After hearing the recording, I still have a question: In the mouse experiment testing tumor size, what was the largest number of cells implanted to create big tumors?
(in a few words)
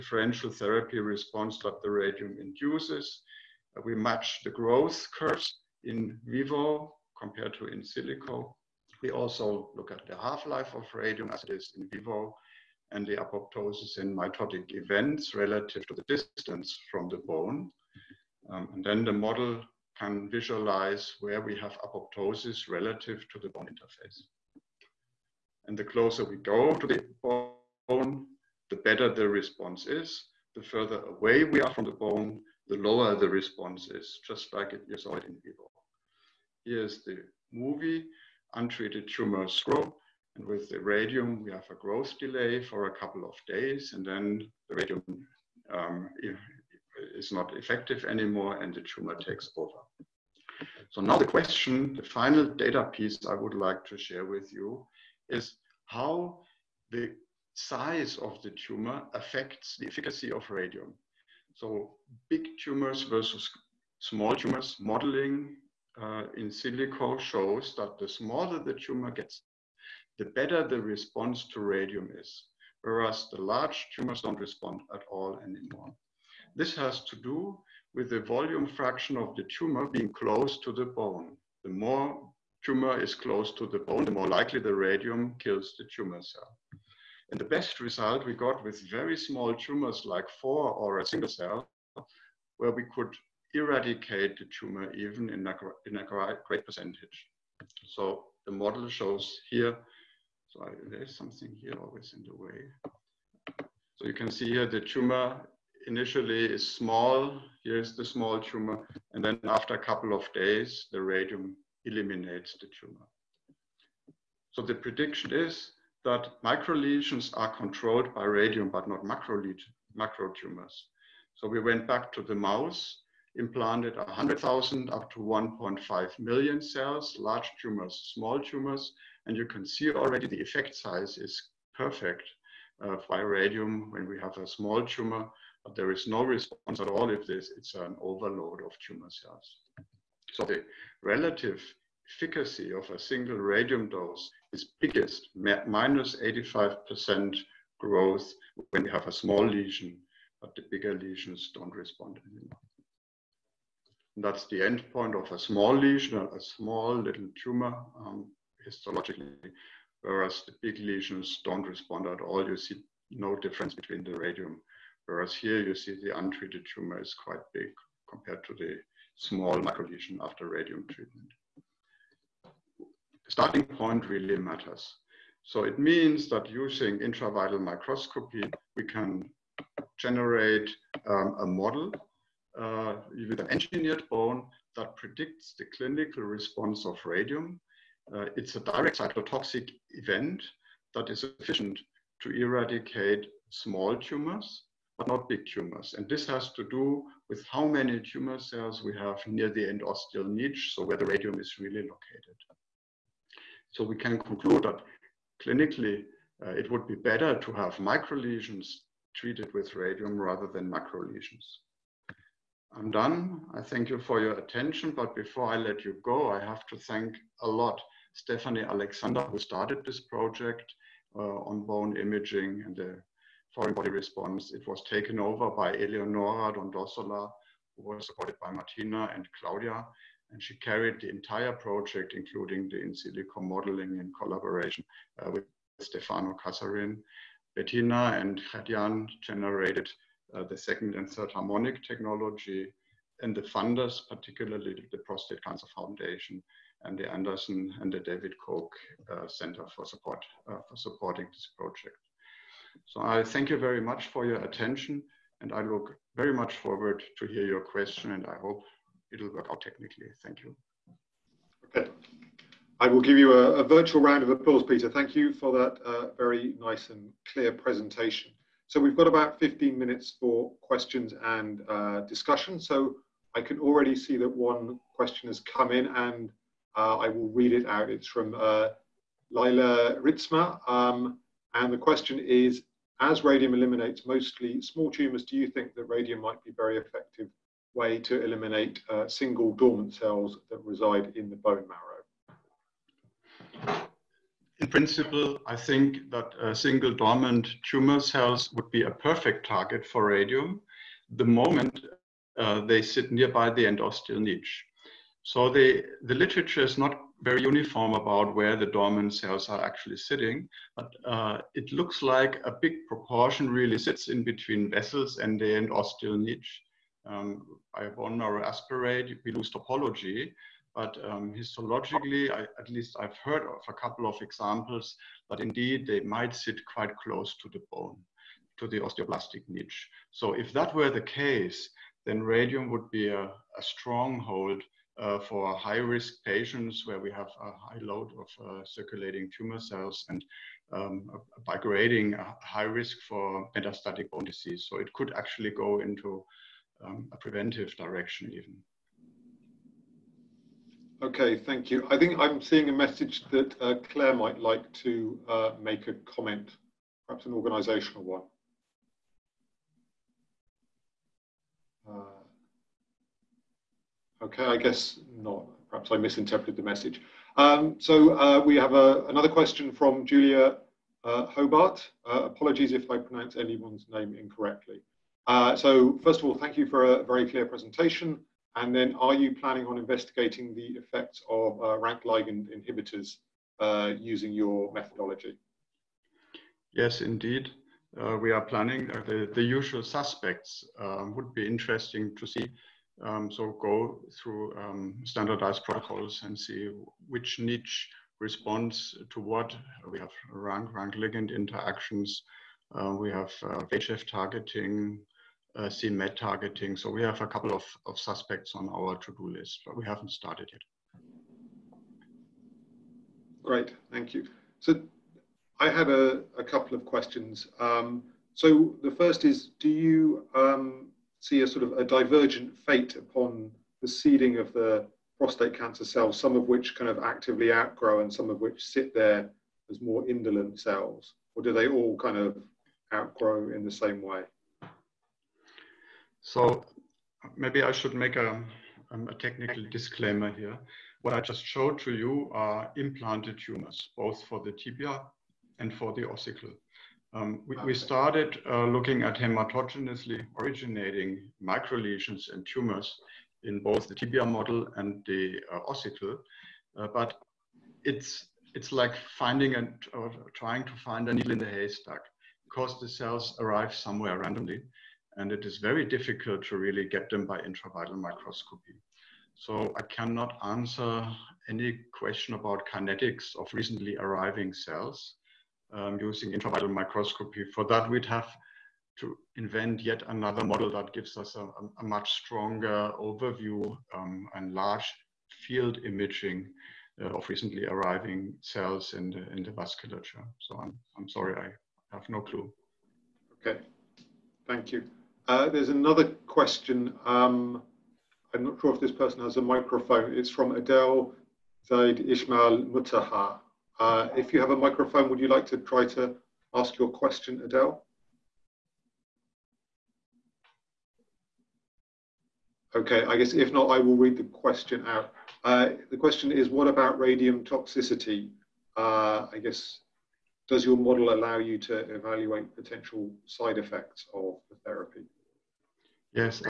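1.5 million.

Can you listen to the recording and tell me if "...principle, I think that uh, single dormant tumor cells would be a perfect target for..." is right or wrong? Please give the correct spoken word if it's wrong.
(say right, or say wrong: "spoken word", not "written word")
right.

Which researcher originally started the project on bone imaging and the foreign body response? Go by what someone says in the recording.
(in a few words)
Stephanie Alexander.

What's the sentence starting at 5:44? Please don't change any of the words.
So it could actually go into um, a preventive direction even.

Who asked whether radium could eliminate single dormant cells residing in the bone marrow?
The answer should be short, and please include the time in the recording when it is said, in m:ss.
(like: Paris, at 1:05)
Laila Ritsma, at 4:39.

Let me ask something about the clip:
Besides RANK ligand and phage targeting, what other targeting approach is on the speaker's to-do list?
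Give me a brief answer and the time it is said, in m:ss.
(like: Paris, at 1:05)
CMET targeting, at 6:45.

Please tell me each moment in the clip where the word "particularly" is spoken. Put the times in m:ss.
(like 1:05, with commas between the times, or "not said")
4:04.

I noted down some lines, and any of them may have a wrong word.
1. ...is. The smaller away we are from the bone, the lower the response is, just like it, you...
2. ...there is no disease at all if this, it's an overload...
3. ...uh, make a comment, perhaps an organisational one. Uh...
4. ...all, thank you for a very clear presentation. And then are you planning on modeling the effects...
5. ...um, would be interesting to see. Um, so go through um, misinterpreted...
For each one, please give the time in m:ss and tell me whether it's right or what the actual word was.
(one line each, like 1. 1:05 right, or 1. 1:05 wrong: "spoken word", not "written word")
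1. 0:29 wrong: "further", not "smaller"
2. 2:15 wrong: "response", not "disease"
3. 5:55 right
4. 6:16 wrong: "investigating", not "modeling"
5. 6:30 wrong: "standardized", not "misinterpreted".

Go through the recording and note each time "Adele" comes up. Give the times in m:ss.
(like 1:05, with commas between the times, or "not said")
8:20, 8:27.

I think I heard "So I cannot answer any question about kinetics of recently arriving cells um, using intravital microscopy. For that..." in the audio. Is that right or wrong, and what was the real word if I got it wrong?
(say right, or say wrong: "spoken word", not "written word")
right.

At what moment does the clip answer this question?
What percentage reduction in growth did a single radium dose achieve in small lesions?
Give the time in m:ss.
2:26.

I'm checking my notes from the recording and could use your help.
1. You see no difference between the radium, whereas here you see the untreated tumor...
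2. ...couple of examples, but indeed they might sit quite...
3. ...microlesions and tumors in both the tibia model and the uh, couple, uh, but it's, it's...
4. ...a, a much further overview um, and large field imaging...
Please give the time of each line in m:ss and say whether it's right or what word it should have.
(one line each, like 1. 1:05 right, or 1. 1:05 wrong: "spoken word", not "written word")
1. 2:42 right
2. 5:23 right
3. 7:31 wrong: "ossicle", not "couple"
4. 8:01 wrong: "stronger", not "further".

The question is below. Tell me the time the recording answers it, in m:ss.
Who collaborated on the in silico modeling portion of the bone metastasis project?
3:55.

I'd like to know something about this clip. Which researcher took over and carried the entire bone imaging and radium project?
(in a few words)
Eleonora Dondossola.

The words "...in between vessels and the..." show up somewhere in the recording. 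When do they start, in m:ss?
5:14.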